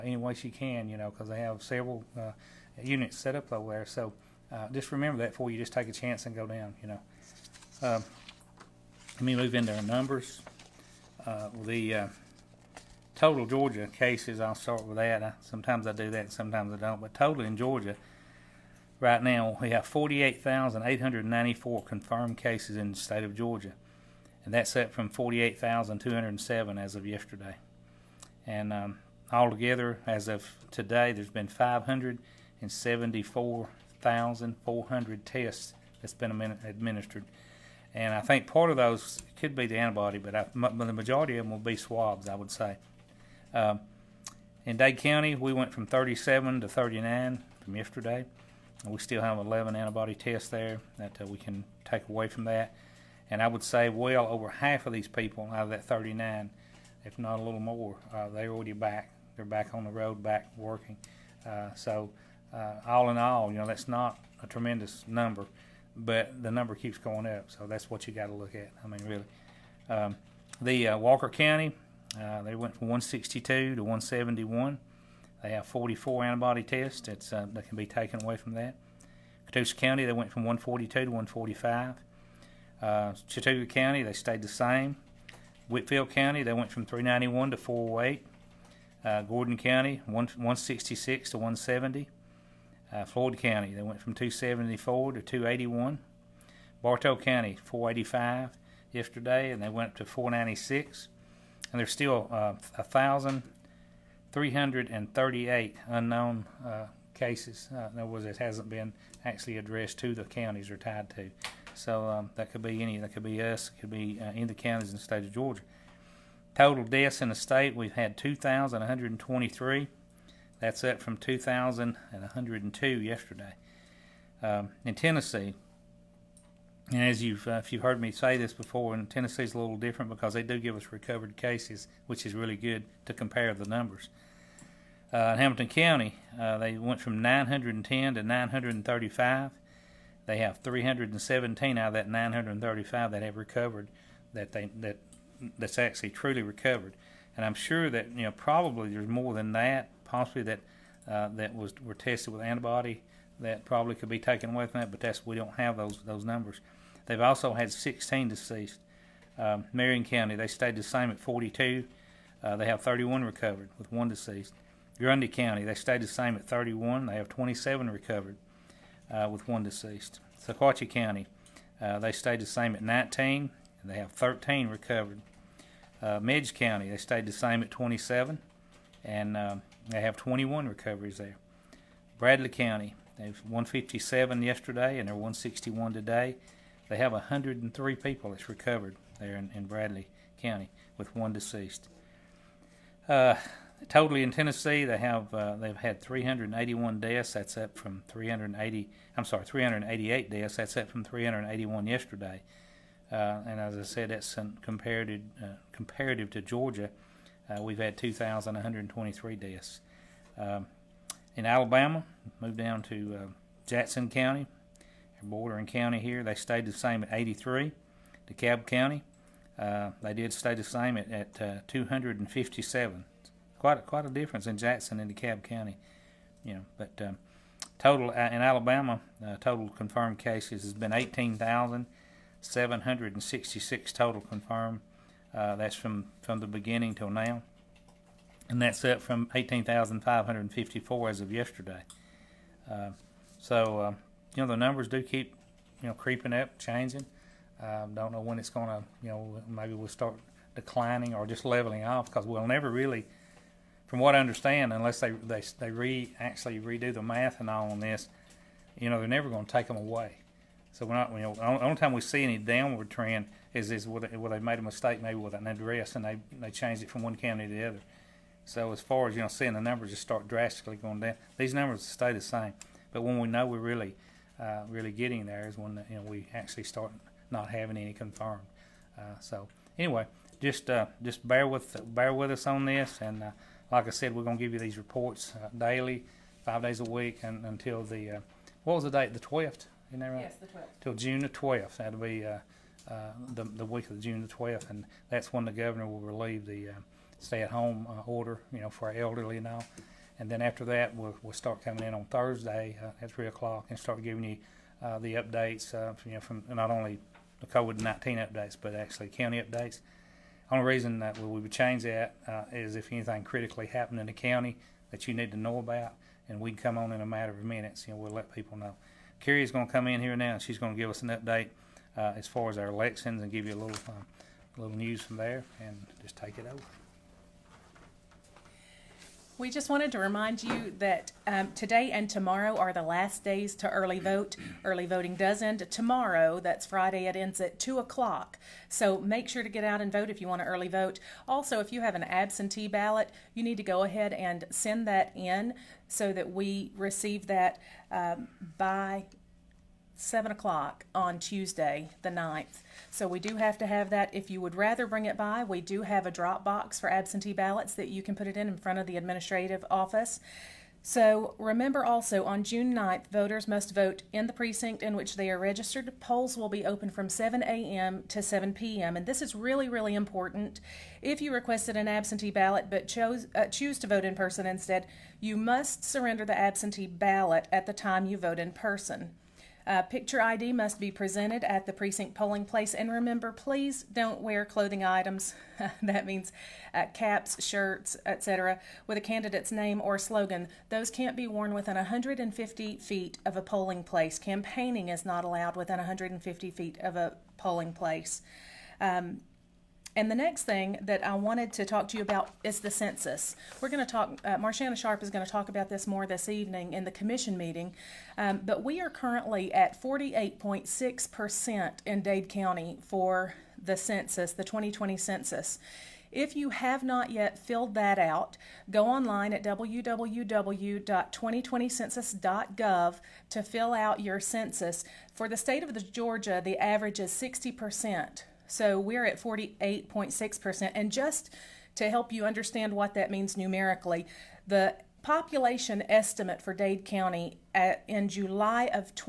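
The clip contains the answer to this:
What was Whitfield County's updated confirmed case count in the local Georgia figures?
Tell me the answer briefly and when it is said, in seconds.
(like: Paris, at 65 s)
408, at 87 s.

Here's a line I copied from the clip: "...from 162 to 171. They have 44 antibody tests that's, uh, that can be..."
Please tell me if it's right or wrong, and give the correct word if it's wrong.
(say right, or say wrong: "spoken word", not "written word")
right.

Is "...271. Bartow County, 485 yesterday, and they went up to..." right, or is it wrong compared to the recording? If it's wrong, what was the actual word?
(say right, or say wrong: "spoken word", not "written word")
wrong: "281", not "271".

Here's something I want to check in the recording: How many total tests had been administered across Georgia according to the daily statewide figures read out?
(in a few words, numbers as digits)
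574,400.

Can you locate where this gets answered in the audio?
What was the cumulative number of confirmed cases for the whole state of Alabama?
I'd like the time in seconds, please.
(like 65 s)
230 s.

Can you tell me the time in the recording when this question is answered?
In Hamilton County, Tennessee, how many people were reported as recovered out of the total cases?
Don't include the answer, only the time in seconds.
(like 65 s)
140 s.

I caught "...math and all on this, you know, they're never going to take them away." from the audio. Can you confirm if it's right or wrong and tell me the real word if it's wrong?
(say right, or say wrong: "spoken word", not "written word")
right.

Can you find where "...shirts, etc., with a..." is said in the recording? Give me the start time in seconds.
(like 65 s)
387 s.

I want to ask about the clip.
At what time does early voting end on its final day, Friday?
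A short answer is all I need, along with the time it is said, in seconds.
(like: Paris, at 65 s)
2 o'clock, at 337 s.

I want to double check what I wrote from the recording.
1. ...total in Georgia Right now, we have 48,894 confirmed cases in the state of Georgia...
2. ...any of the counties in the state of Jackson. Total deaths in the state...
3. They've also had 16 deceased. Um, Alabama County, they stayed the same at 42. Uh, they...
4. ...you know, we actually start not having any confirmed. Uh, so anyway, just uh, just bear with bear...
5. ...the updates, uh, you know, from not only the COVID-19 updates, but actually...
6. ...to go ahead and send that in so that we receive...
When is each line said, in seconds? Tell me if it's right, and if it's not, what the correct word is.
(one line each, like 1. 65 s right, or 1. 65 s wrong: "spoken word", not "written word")
1. 17 s right
2. 114 s wrong: "Georgia", not "Jackson"
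3. 157 s wrong: "Marion", not "Alabama"
4. 275 s right
5. 304 s right
6. 343 s right.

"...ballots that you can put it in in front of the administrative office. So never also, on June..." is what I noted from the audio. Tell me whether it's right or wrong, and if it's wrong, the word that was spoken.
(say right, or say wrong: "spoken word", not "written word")
wrong: "remember", not "never".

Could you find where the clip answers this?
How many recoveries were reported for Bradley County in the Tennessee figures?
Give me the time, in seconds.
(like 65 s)
187 s.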